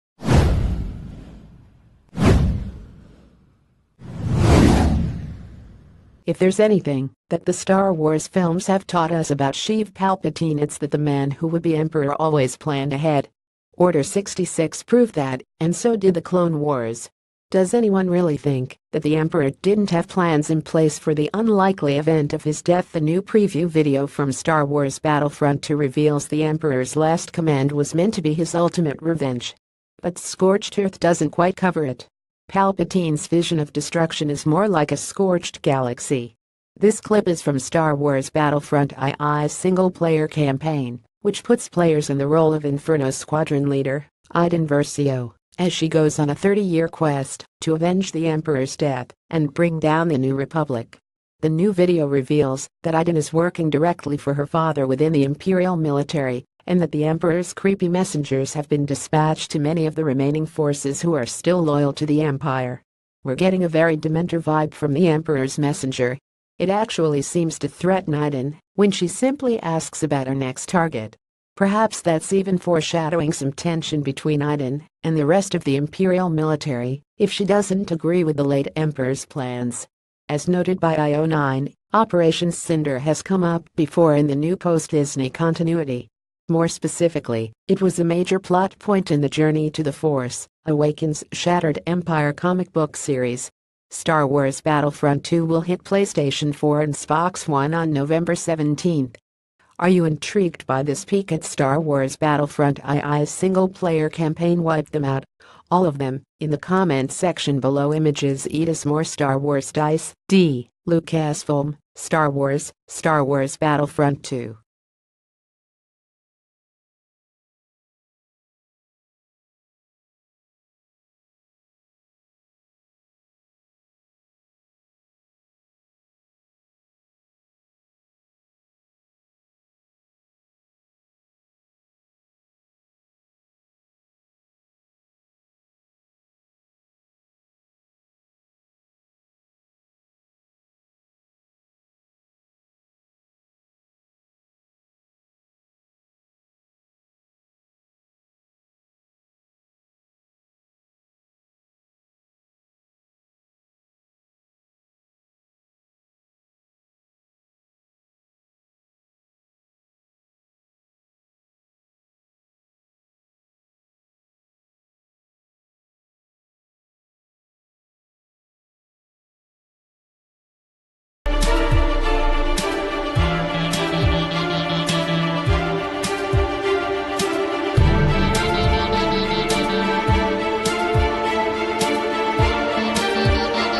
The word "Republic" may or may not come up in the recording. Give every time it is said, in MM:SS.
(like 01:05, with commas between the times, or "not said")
00:50.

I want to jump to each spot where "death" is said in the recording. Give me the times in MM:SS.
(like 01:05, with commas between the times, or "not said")
00:22, 00:48.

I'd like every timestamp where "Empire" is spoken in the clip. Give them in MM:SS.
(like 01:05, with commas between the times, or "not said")
01:02, 01:31.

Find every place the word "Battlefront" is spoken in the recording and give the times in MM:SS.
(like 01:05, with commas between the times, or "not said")
00:24, 00:38, 01:34, 01:42, 01:53.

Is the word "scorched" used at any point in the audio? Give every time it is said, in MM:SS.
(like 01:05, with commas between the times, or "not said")
00:30, 00:34.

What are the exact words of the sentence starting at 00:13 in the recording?
Order 66 proved that, and so did the Clone Wars.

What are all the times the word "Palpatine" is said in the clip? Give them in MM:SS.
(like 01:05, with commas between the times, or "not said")
00:09, 00:32.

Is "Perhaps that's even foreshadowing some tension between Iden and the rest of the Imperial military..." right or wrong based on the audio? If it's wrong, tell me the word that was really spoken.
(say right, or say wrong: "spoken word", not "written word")
right.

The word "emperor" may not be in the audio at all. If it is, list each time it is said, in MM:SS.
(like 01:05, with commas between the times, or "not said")
00:11, 00:19, 00:26, 00:48, 00:57, 01:05, 01:18.